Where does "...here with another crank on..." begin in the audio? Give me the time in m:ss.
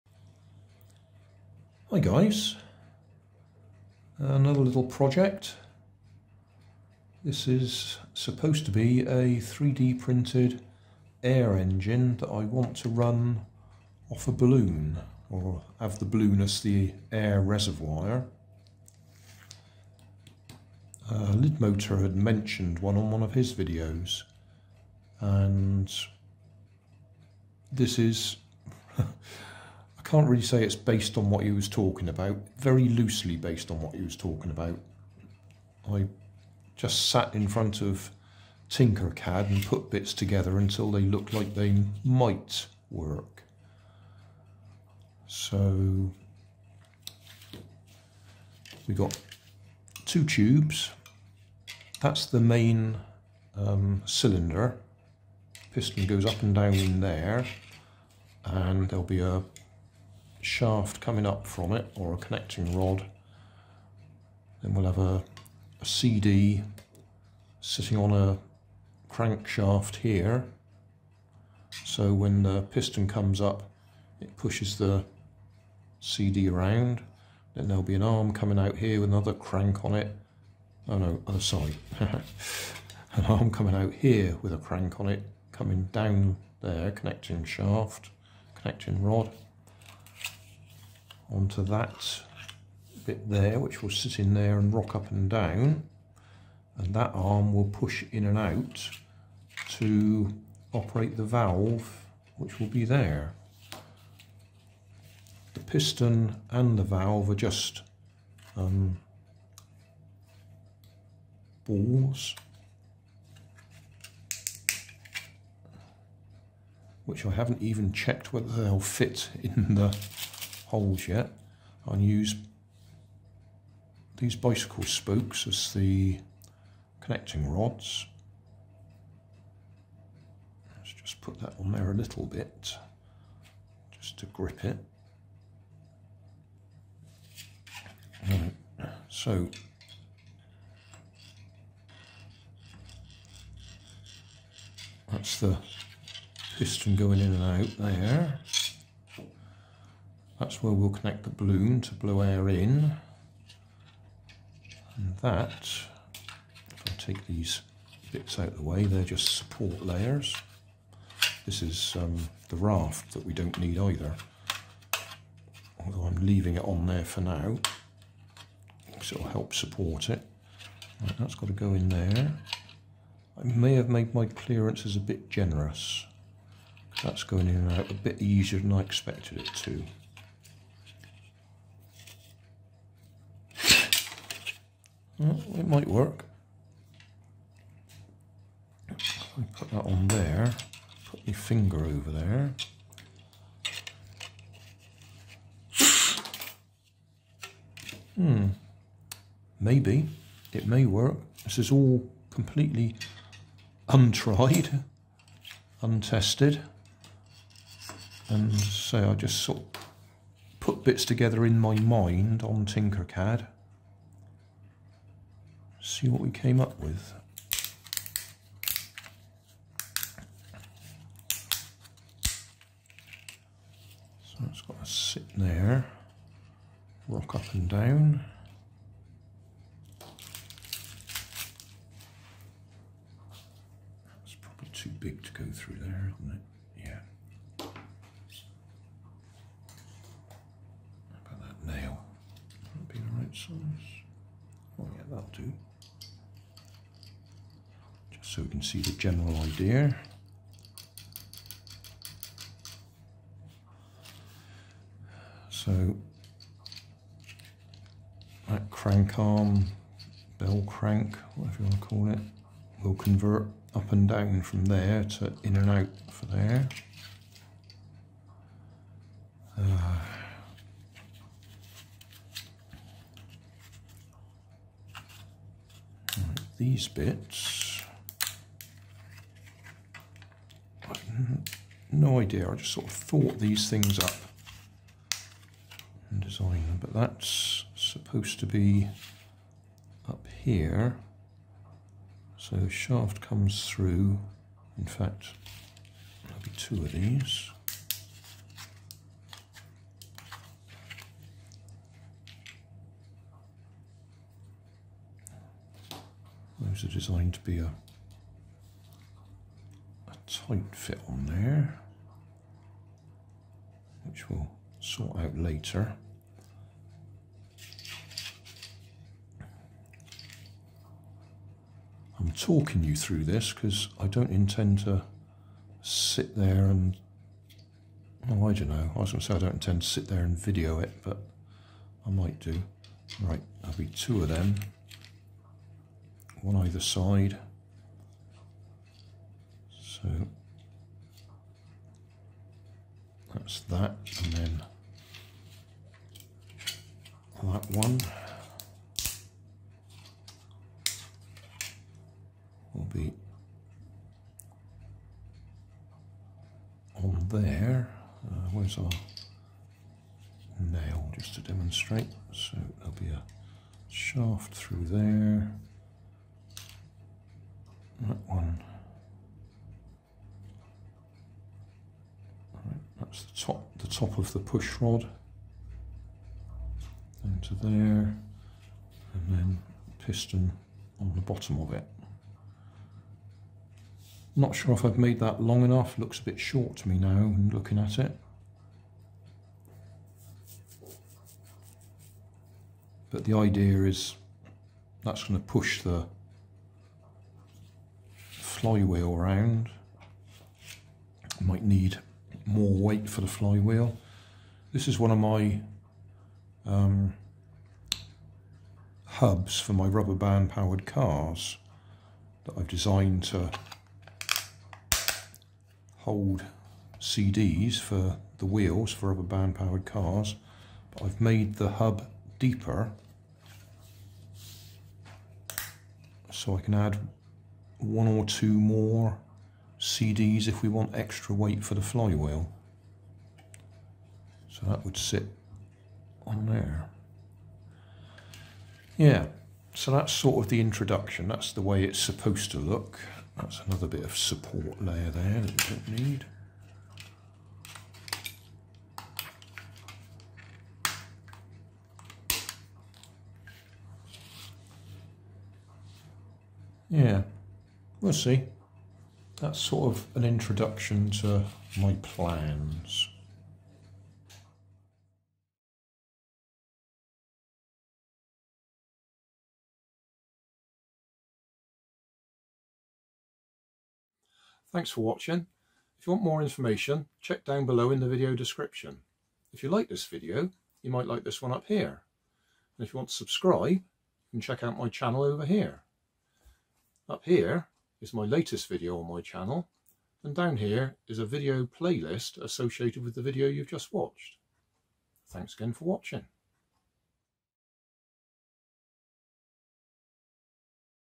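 1:18.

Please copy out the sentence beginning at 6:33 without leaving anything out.
But the idea is that's going to push the flywheel around.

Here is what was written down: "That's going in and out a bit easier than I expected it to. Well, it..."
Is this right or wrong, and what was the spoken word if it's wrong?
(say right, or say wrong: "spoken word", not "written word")
right.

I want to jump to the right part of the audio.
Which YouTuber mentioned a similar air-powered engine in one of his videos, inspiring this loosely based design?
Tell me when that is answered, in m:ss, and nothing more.
0:21.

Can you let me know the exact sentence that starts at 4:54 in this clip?
In fact, there'll be two of these.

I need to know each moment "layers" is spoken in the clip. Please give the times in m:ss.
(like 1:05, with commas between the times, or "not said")
2:39, 7:24.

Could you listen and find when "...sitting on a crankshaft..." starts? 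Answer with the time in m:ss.
1:07.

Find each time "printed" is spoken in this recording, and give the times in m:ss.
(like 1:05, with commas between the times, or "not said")
0:09.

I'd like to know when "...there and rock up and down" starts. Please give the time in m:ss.
1:34.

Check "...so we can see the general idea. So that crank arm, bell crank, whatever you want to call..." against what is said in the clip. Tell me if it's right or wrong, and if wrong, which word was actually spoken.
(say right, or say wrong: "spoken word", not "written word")
right.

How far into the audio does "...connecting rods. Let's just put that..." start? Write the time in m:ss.
2:07.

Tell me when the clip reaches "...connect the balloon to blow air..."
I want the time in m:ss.
2:30.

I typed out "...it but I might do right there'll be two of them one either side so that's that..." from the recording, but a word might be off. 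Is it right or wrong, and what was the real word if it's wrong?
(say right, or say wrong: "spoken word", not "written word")
right.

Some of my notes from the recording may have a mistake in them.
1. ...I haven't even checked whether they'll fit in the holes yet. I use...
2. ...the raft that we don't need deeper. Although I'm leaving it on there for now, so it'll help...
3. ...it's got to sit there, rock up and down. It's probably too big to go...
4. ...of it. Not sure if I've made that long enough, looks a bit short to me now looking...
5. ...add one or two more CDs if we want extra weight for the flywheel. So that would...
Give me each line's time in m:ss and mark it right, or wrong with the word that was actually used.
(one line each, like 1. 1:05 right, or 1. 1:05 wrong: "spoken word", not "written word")
1. 1:57 right
2. 2:42 wrong: "either", not "deeper"
3. 3:44 right
4. 6:21 right
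5. 7:06 right.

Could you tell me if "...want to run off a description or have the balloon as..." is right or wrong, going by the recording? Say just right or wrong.
wrong.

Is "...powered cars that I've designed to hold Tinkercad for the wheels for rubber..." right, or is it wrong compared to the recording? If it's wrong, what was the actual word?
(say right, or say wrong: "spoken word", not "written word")
wrong: "CDs", not "Tinkercad".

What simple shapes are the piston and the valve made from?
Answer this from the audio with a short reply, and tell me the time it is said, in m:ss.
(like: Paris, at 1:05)
Balls, at 1:51.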